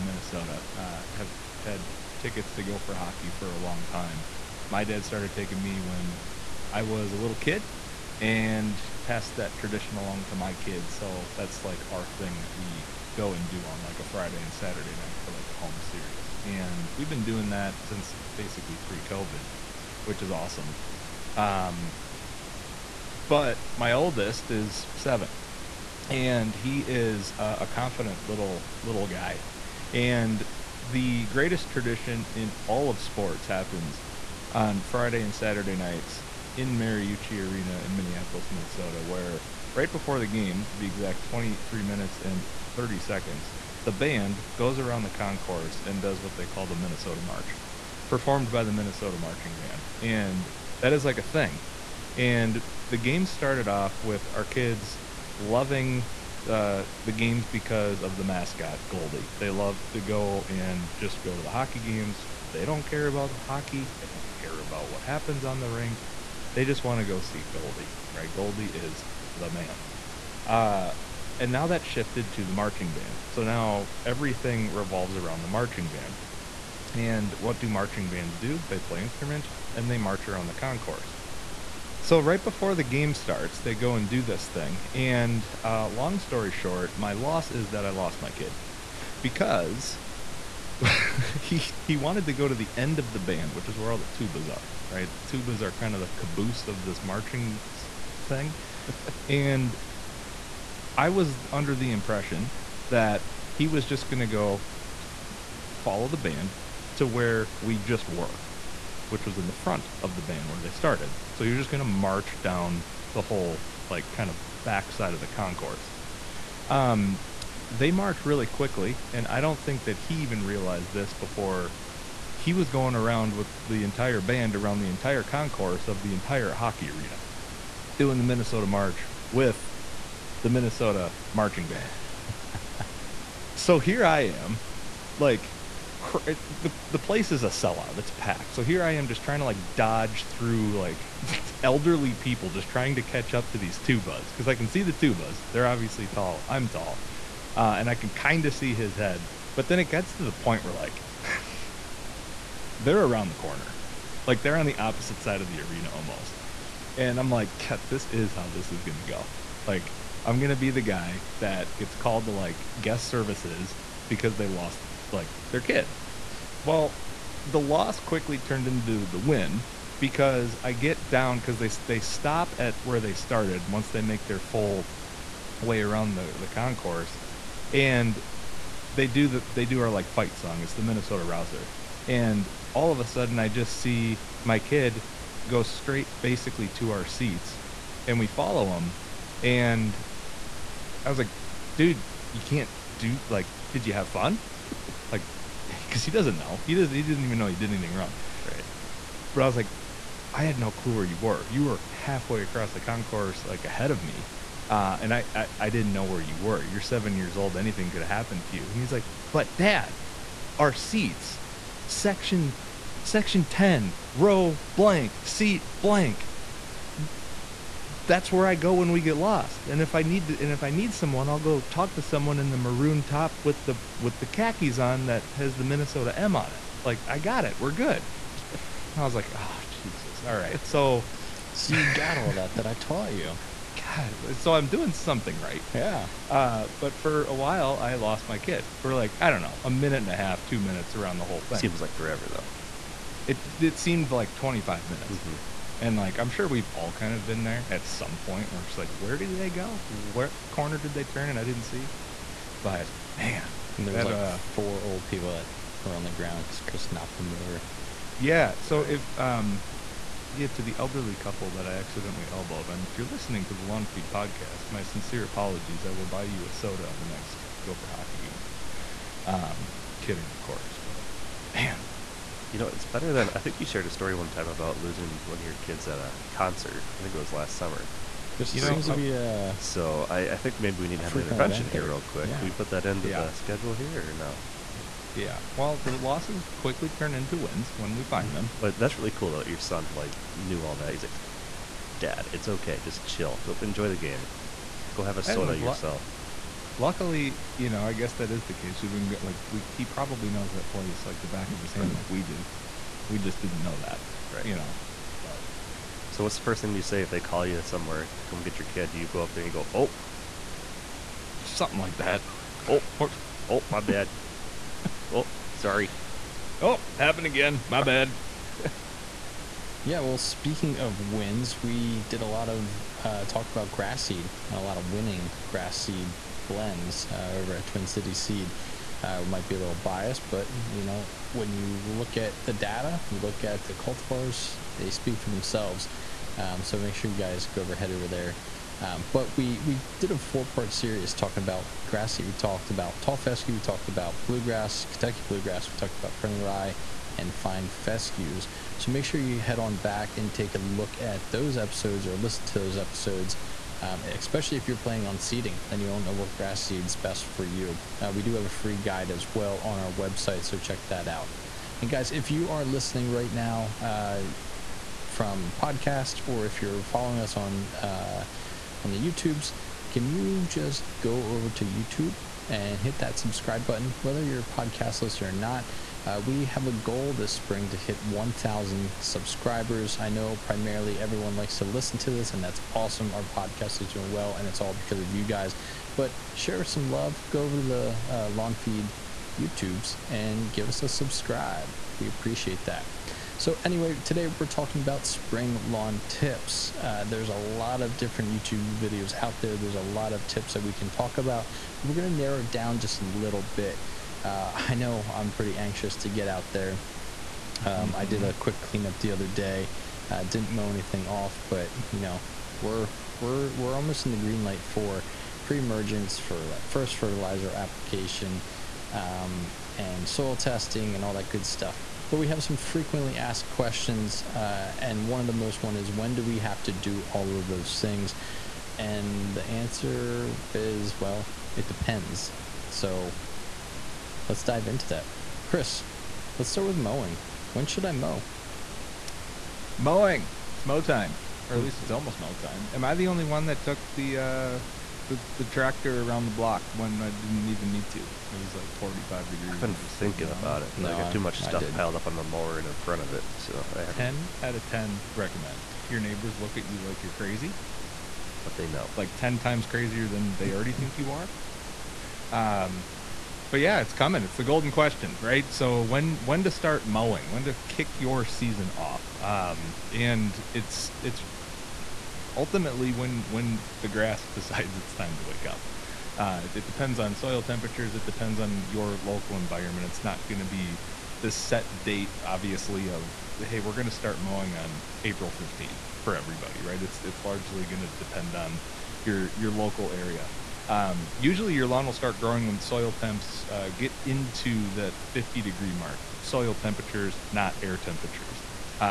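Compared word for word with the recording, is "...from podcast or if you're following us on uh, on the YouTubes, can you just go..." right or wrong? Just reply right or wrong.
right.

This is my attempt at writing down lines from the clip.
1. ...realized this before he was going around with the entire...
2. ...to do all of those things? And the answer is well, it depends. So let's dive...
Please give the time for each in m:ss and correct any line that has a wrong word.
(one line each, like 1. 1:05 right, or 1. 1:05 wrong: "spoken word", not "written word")
1. 2:00 right
2. 7:06 right.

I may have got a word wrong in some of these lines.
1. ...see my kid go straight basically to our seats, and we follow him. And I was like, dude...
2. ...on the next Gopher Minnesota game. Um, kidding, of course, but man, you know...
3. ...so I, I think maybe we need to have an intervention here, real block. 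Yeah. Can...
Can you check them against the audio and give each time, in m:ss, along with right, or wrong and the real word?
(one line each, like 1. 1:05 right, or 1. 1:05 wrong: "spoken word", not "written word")
1. 3:03 right
2. 4:26 wrong: "Hockey", not "Minnesota"
3. 4:39 wrong: "quick", not "block".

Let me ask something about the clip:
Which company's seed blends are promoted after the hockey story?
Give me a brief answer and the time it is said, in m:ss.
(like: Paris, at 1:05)
Twin City Seed, at 5:27.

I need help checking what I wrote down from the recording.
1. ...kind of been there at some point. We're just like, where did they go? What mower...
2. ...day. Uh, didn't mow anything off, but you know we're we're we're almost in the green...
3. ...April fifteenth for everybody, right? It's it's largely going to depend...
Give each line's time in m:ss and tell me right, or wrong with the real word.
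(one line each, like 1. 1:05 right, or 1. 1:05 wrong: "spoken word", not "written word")
1. 4:06 wrong: "corner", not "mower"
2. 6:49 right
3. 8:05 right.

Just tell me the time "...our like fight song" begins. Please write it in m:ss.
2:59.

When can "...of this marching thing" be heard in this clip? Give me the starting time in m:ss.
1:36.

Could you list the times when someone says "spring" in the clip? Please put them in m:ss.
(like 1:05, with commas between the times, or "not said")
6:17, 6:35.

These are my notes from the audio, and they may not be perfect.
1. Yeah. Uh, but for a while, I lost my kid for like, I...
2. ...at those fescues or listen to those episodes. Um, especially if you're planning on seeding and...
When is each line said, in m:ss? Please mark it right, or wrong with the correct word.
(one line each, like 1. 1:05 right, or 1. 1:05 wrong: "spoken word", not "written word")
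1. 3:55 right
2. 5:50 wrong: "episodes", not "fescues".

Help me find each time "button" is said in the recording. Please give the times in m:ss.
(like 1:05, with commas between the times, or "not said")
6:13.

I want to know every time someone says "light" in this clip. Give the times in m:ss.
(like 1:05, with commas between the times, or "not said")
6:54.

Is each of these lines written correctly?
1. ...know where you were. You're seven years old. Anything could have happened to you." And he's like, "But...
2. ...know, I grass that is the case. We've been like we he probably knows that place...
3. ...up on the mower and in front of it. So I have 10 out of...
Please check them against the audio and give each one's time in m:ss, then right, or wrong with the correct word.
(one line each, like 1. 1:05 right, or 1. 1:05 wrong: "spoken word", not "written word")
1. 3:25 right
2. 4:57 wrong: "guess", not "grass"
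3. 7:31 right.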